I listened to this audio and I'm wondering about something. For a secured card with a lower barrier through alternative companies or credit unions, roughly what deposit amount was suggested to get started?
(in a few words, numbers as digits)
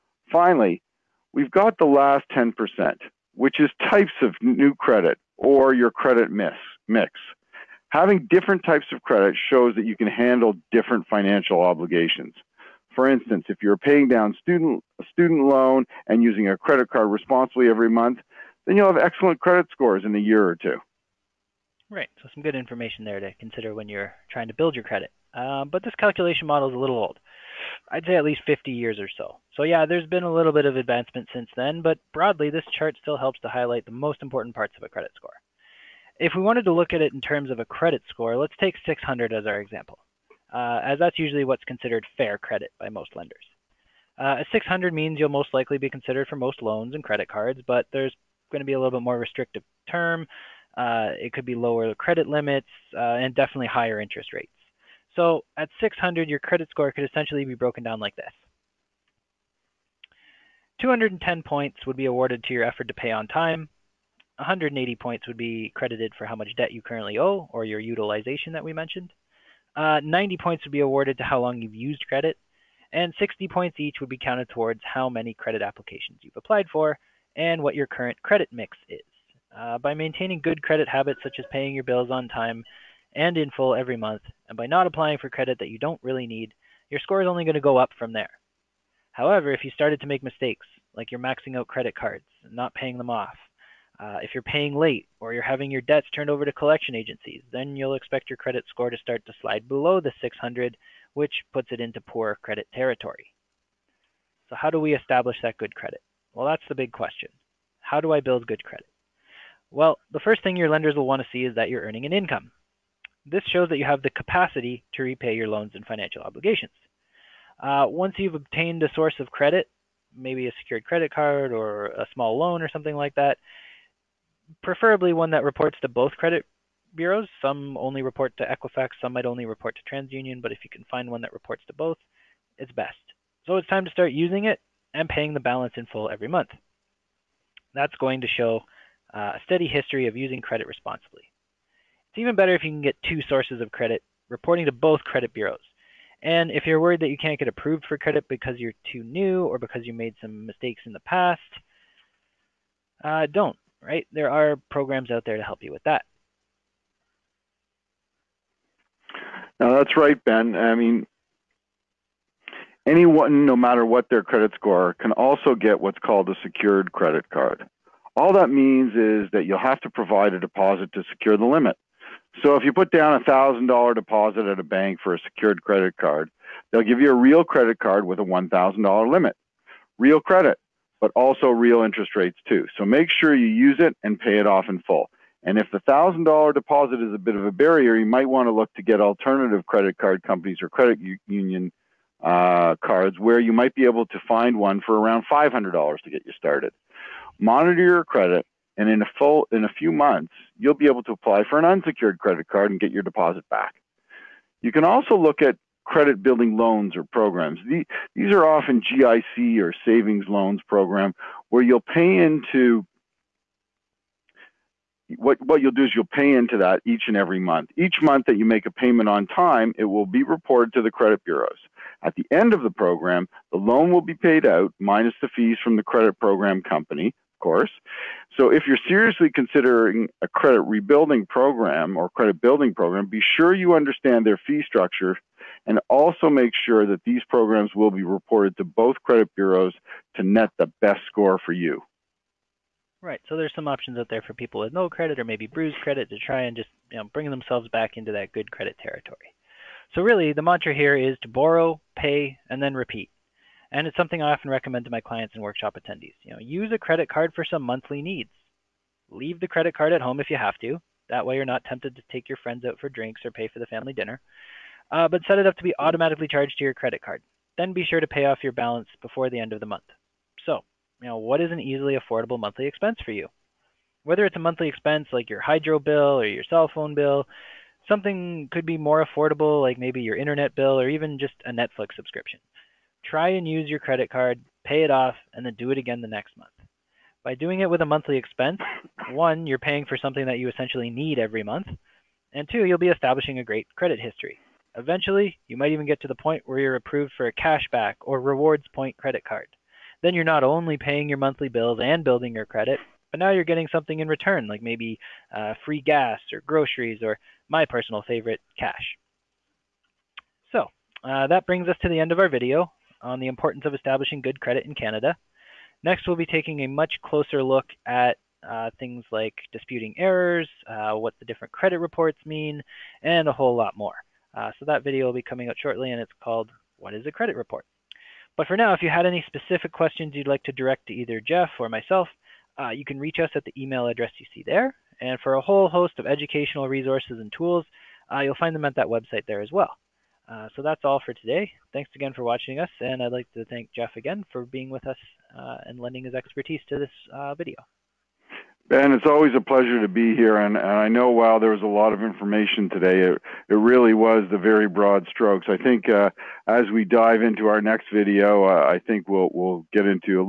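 $500.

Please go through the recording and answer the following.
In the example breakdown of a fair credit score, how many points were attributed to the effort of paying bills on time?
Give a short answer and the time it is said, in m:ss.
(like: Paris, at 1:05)
210, at 1:00.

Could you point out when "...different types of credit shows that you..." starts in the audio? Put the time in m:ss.
0:08.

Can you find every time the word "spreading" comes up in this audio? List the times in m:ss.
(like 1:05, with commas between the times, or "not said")
not said.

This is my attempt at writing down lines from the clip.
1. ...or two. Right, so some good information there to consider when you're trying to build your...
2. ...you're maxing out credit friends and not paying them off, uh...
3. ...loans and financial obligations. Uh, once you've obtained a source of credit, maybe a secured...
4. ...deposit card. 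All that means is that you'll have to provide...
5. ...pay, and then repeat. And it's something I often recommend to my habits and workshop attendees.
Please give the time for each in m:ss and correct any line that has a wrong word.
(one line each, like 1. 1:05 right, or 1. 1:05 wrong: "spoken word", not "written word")
1. 0:20 right
2. 1:31 wrong: "cards", not "friends"
3. 1:55 right
4. 2:46 wrong: "credit", not "deposit"
5. 4:11 wrong: "clients", not "habits".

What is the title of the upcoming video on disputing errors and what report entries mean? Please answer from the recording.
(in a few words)
What is a Credit Report?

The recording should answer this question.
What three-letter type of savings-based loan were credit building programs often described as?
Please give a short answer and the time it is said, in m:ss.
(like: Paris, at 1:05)
GIC, at 3:28.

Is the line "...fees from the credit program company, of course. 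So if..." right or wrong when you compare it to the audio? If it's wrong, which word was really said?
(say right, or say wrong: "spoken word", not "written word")
right.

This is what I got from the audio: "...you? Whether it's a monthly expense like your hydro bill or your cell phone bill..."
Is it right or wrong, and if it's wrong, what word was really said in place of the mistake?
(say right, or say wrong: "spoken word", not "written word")
right.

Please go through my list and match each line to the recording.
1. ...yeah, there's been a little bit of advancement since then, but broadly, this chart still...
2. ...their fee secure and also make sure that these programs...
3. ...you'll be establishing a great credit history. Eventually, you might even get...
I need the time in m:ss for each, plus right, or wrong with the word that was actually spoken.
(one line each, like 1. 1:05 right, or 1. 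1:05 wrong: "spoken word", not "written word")
1. 0:29 right
2. 3:54 wrong: "structure", not "secure"
3. 4:52 right.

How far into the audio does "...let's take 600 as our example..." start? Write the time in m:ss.
0:38.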